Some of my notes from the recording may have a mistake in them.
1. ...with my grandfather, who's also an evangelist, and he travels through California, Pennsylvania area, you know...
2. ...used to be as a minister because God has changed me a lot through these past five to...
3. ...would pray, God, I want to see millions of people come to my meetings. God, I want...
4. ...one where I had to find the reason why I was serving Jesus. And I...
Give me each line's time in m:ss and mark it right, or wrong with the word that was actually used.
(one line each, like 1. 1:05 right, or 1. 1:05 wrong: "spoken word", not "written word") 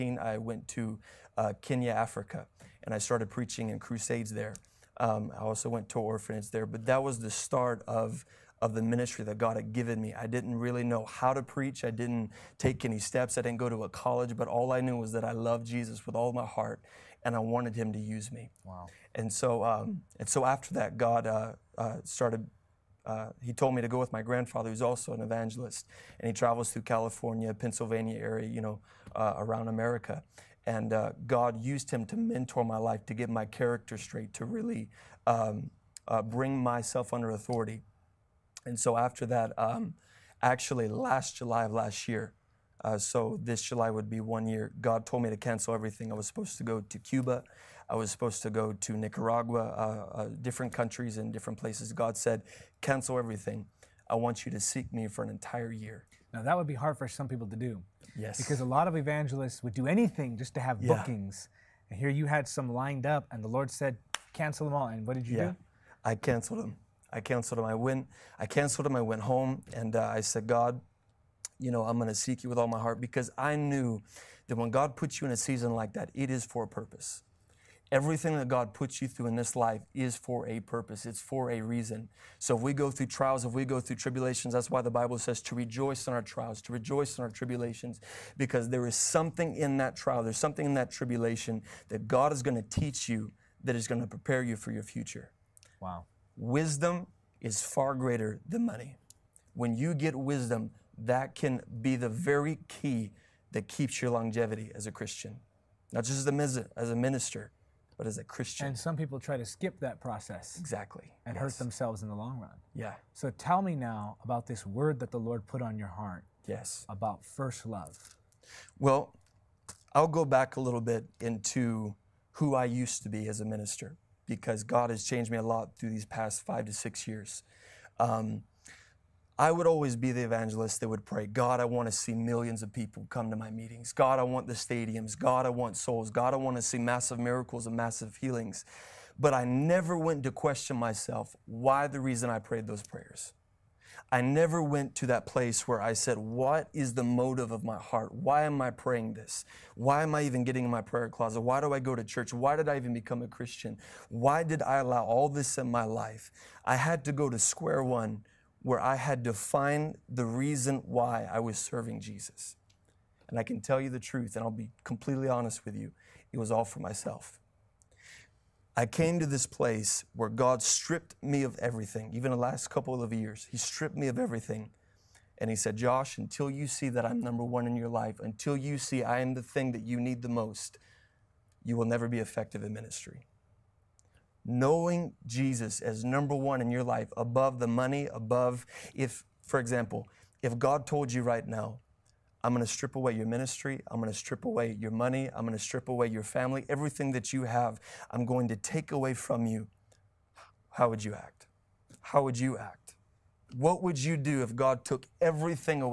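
1. 0:23 right
2. 2:02 right
3. 2:10 right
4. 2:37 right.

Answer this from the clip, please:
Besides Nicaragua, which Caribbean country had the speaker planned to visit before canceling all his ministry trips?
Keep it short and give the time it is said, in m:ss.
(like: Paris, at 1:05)
Cuba, at 0:46.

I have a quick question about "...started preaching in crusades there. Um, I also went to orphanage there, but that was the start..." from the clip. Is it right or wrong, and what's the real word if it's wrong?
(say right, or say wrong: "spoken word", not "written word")
right.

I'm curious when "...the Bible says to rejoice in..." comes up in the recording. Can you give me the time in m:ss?
1:24.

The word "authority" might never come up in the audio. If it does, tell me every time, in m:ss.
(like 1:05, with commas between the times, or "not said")
0:37.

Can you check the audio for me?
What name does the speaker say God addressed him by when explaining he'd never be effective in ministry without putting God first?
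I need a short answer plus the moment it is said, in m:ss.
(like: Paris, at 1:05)
Josh, at 2:55.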